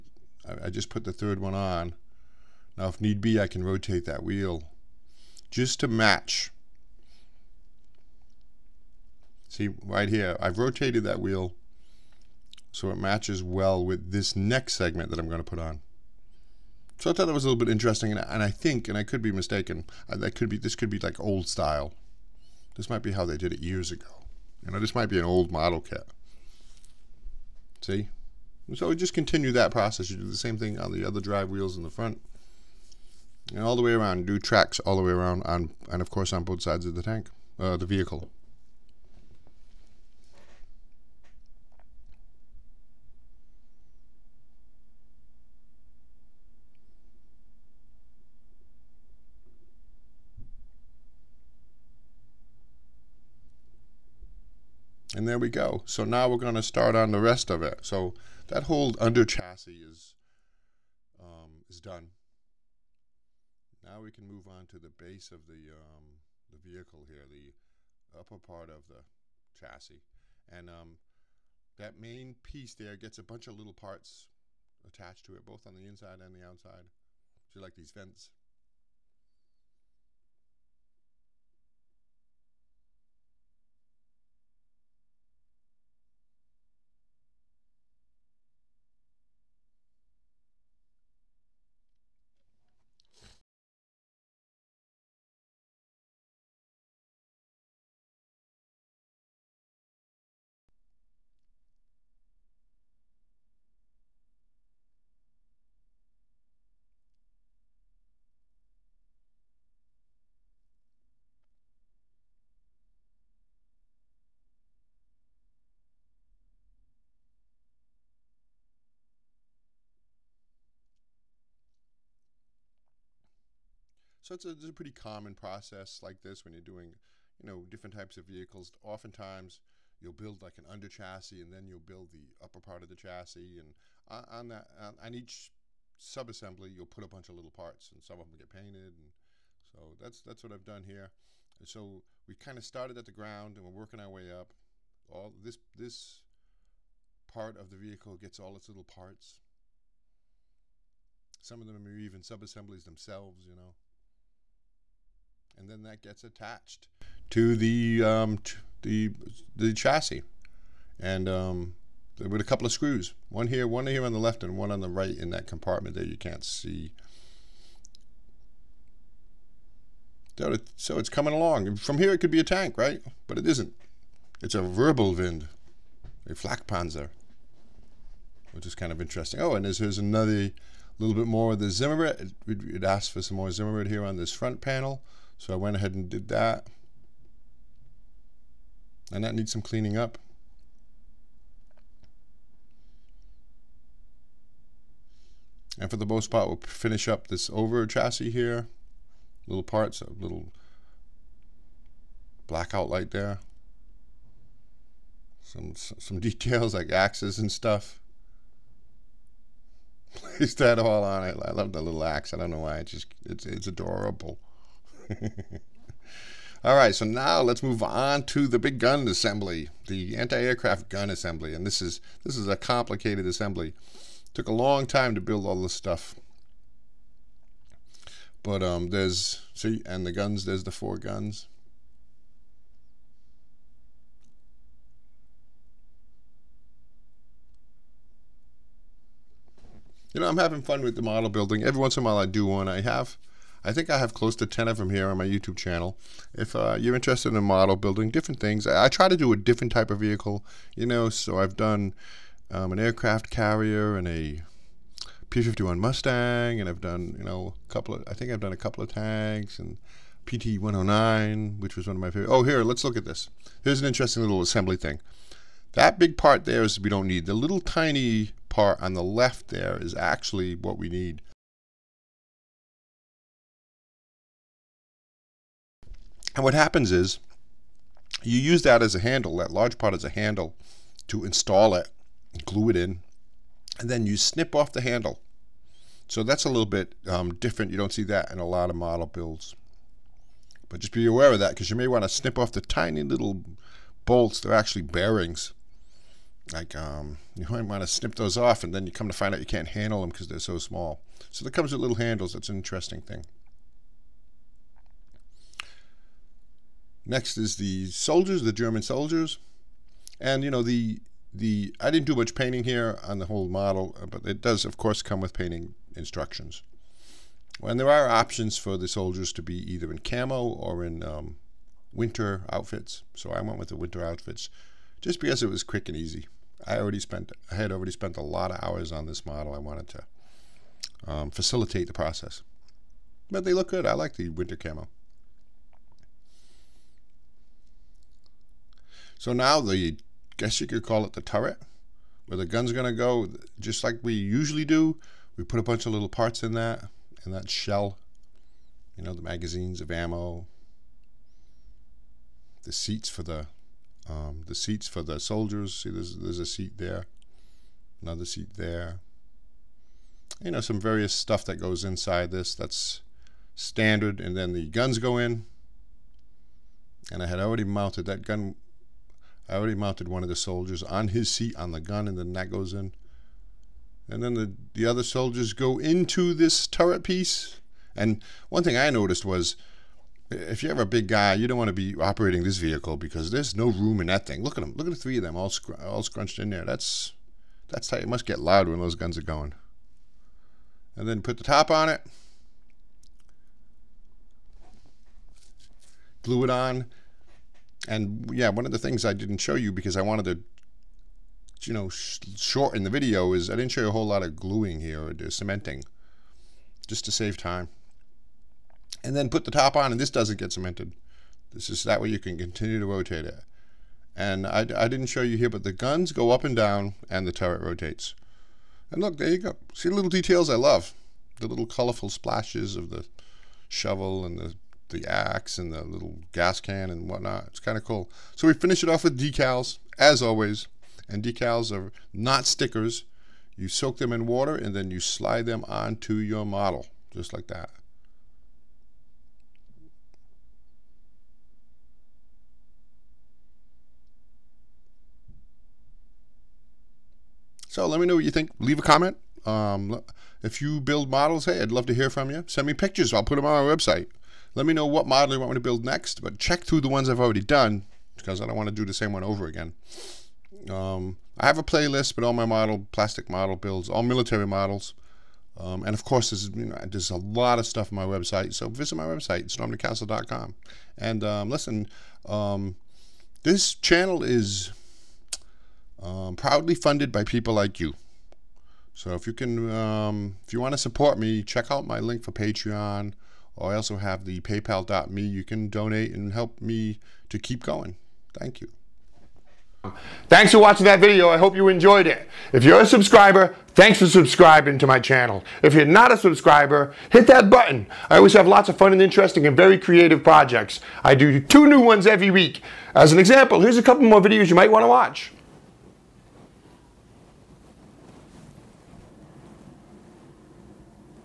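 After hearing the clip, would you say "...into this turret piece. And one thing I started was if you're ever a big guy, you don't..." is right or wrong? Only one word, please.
wrong.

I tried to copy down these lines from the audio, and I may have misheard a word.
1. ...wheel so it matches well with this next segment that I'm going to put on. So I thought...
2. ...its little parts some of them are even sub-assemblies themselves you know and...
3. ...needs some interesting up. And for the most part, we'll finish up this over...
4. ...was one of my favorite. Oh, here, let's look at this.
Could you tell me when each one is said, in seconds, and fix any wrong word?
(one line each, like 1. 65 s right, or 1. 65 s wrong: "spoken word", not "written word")
1. 11 s right
2. 148 s right
3. 189 s wrong: "cleaning", not "interesting"
4. 261 s right.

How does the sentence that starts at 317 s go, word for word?
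And there are options for the soldiers to be either in camo or in um, winter outfits.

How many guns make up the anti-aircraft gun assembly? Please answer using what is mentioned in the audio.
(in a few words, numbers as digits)
4.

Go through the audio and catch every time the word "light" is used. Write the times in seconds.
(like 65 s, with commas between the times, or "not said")
202 s.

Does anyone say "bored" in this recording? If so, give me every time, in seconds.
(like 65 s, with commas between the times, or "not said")
not said.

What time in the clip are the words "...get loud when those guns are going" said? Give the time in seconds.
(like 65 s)
388 s.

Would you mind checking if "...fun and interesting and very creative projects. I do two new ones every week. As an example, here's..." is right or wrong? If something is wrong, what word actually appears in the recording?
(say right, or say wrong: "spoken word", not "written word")
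right.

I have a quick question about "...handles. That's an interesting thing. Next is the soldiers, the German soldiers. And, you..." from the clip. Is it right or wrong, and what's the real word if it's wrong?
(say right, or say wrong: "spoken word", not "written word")
right.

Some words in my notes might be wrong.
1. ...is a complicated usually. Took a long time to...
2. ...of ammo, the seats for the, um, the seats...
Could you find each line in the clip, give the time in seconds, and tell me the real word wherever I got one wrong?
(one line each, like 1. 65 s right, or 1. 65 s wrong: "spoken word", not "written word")
1. 222 s wrong: "assembly", not "usually"
2. 349 s right.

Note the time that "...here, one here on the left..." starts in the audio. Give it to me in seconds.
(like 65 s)
163 s.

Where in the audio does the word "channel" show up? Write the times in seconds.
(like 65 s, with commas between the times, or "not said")
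245 s, 473 s, 494 s.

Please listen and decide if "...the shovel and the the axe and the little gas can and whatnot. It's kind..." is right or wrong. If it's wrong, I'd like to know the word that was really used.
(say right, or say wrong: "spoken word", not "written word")
right.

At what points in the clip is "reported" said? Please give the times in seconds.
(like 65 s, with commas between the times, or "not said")
not said.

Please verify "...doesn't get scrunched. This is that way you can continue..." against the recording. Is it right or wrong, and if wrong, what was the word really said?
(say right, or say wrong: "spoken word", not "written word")
wrong: "cemented", not "scrunched".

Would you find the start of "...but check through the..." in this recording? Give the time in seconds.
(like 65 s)
456 s.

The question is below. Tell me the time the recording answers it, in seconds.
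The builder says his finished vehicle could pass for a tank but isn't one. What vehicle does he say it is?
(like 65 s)
174 s.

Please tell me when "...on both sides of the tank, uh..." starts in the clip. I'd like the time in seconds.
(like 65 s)
36 s.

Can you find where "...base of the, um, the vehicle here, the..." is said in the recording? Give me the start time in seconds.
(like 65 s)
64 s.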